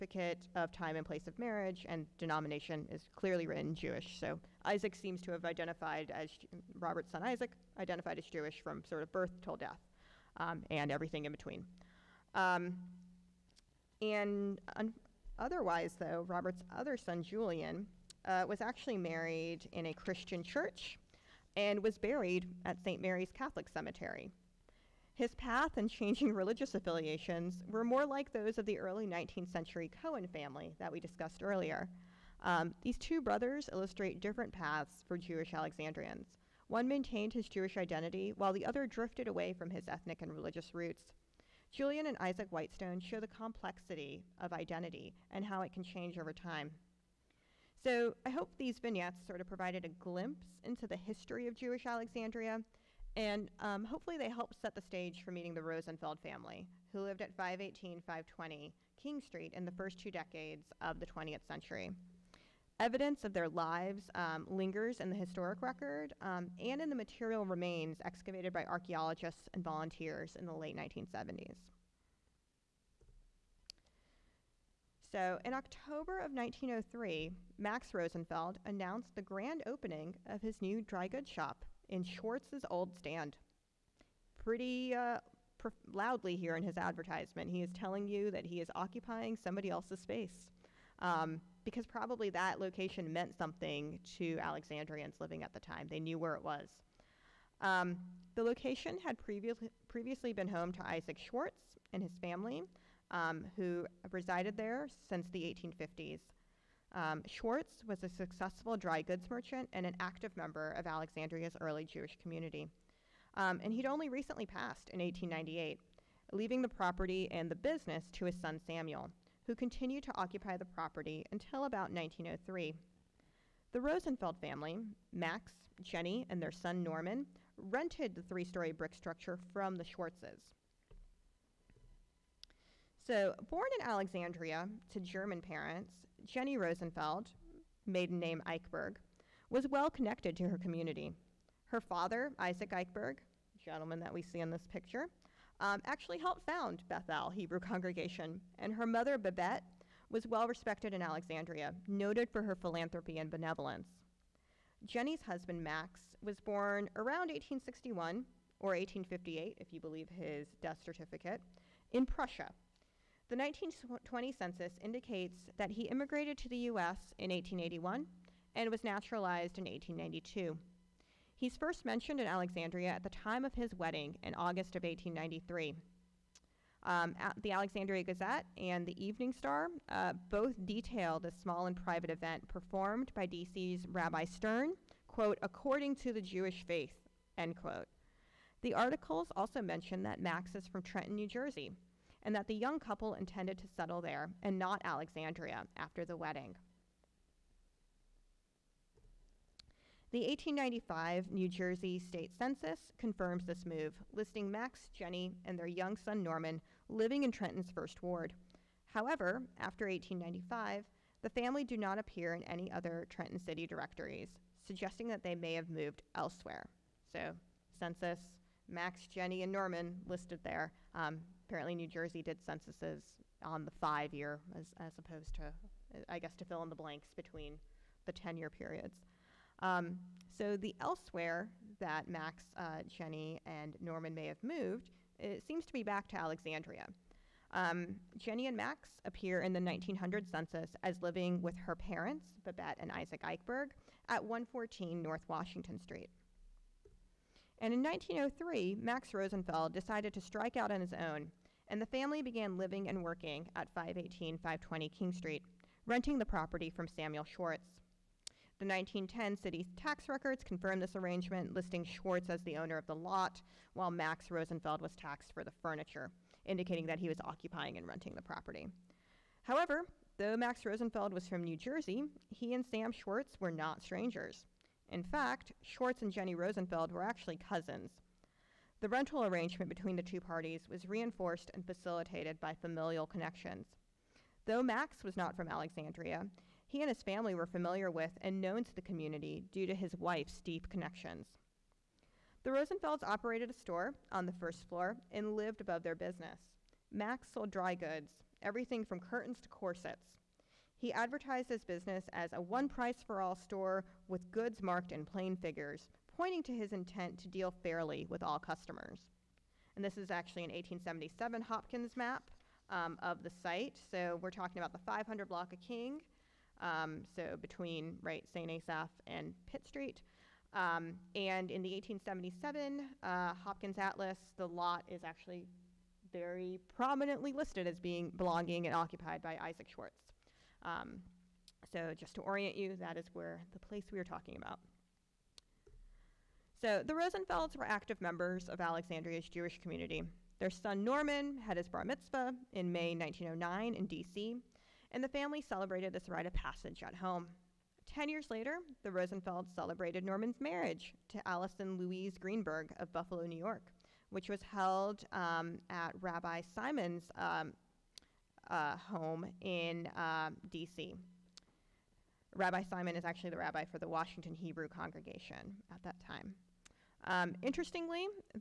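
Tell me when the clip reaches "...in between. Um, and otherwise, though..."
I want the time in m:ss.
0:11.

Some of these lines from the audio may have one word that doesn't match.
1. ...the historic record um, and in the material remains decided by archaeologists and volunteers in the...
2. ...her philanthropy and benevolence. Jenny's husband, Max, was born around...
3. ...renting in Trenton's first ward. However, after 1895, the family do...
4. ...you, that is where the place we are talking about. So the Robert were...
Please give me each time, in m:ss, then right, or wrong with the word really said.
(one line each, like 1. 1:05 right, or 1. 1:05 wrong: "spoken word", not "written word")
1. 1:05 wrong: "excavated", not "decided"
2. 2:32 right
3. 3:26 wrong: "living", not "renting"
4. 5:32 wrong: "Rosenfelds", not "Robert".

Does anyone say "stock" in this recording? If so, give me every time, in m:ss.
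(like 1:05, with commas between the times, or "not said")
not said.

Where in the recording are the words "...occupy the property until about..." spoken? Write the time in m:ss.
2:00.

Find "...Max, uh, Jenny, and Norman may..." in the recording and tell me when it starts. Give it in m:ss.
3:52.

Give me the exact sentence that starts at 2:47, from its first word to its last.
in 1881 and was naturalized in 1892.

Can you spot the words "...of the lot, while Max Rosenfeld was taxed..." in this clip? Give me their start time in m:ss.
4:22.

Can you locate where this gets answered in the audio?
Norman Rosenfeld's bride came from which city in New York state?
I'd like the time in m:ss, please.
5:52.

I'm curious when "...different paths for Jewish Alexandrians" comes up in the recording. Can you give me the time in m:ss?
0:34.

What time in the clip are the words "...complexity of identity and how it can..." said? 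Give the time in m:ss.
0:43.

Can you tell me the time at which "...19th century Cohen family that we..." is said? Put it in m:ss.
0:29.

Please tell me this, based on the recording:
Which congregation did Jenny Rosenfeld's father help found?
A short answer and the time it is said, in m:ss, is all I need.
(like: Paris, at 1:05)
Bethel Hebrew Congregation, at 2:26.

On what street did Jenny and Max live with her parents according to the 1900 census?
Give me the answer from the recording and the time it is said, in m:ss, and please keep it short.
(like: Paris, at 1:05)
114 North Washington Street, at 4:04.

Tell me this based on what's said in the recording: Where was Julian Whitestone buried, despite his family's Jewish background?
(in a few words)
St. Mary's Catholic Cemetery.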